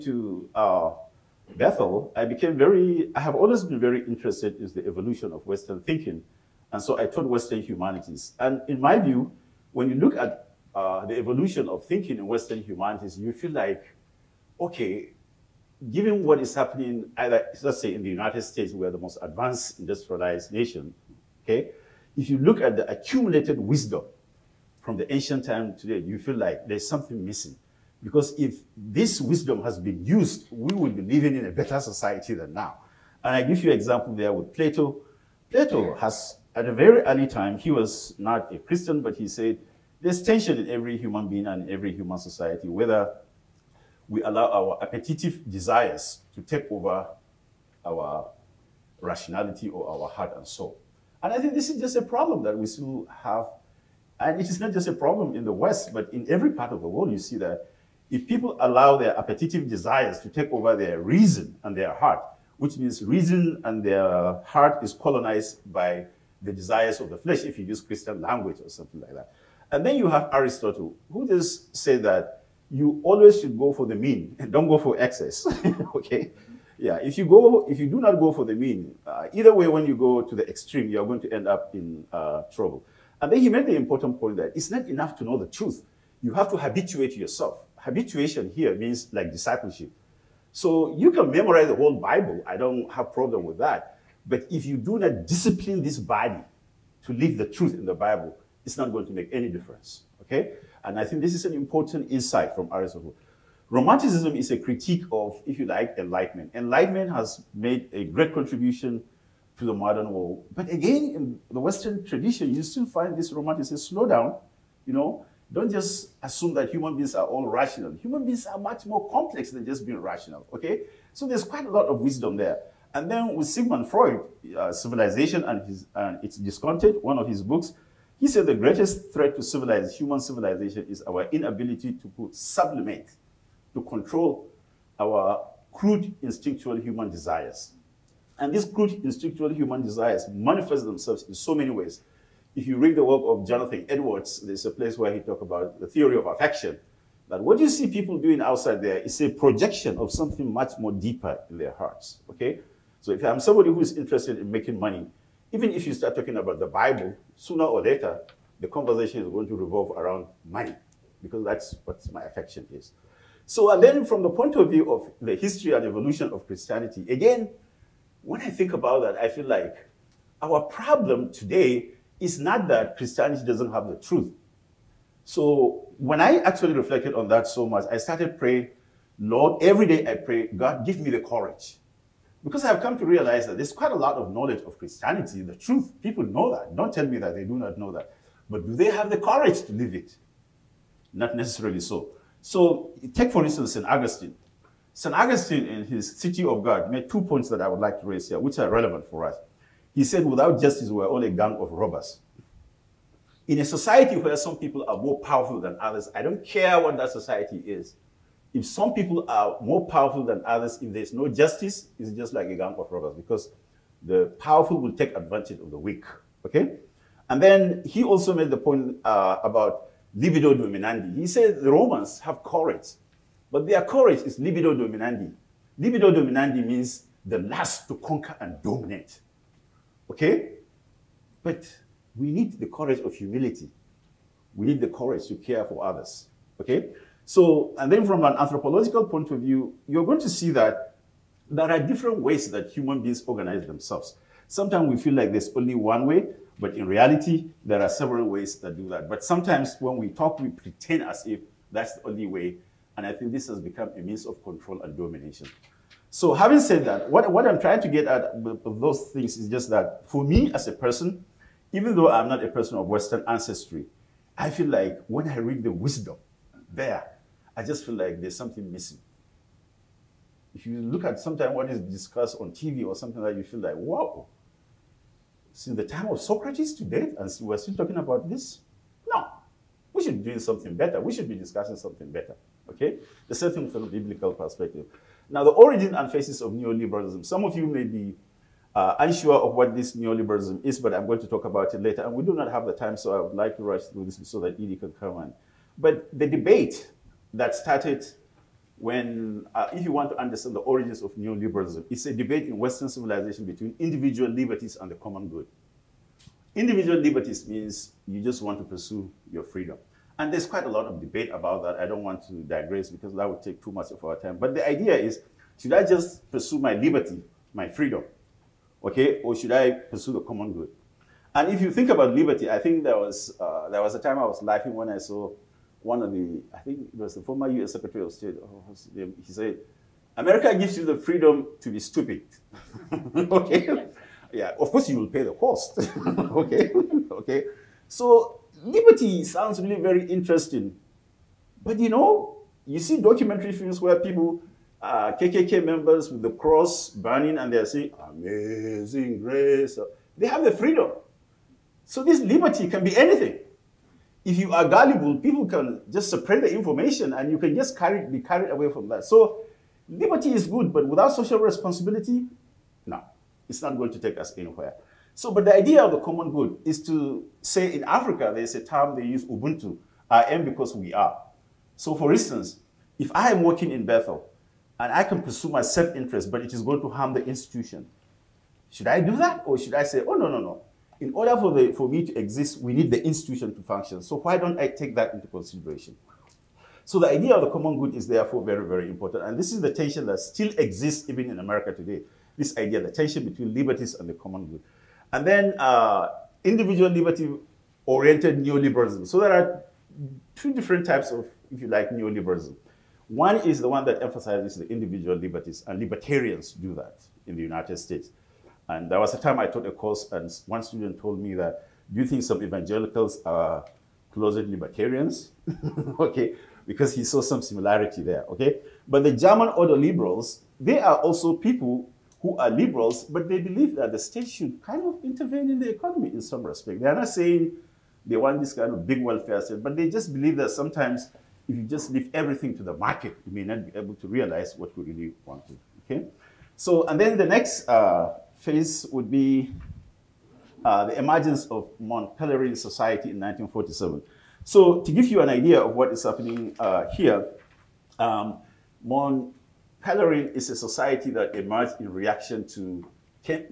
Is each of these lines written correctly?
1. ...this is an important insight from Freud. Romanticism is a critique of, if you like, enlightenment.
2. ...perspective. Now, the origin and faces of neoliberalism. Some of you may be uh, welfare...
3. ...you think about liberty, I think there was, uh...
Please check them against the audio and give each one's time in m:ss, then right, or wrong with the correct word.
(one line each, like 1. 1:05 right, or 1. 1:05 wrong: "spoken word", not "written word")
1. 1:41 wrong: "Aristotle", not "Freud"
2. 4:44 wrong: "unsure", not "welfare"
3. 5:21 right.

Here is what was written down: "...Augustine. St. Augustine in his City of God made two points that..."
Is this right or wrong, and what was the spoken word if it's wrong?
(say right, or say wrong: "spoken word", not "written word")
right.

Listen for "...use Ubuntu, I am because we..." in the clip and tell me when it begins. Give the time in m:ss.
6:09.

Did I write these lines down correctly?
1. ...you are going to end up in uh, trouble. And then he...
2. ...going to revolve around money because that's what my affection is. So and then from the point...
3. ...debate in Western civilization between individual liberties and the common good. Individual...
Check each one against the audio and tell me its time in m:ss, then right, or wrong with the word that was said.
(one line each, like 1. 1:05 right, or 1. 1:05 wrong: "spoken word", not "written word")
1. 1:20 right
2. 2:39 right
3. 5:02 right.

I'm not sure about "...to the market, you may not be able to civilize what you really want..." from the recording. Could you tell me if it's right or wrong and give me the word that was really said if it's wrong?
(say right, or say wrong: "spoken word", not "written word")
wrong: "realize", not "civilize".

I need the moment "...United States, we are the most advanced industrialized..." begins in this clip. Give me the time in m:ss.
0:18.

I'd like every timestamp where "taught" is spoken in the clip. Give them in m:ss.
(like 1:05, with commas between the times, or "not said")
0:07, 6:49.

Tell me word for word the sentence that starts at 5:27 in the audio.
Secretary of State, oh, he said, America gives you the freedom to be stupid.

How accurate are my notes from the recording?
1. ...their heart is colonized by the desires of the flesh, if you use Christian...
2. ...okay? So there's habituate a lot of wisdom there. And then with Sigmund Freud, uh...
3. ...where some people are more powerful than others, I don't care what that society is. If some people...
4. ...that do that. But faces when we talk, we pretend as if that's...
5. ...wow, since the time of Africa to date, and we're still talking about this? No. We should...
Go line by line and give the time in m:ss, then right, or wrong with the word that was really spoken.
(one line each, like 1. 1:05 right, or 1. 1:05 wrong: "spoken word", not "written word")
1. 1:03 right
2. 2:00 wrong: "quite", not "habituate"
3. 3:24 right
4. 4:08 wrong: "sometimes", not "faces"
5. 4:33 wrong: "Socrates", not "Africa".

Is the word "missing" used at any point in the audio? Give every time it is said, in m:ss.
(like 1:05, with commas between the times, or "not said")
0:27, 4:28.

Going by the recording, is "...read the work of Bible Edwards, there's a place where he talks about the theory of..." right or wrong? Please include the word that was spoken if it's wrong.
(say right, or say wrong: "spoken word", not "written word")
wrong: "Jonathan", not "Bible".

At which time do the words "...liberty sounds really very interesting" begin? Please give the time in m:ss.
5:38.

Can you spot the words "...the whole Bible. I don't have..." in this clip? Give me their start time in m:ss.
1:31.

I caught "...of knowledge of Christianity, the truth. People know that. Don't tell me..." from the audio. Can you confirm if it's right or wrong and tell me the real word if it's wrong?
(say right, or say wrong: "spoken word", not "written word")
right.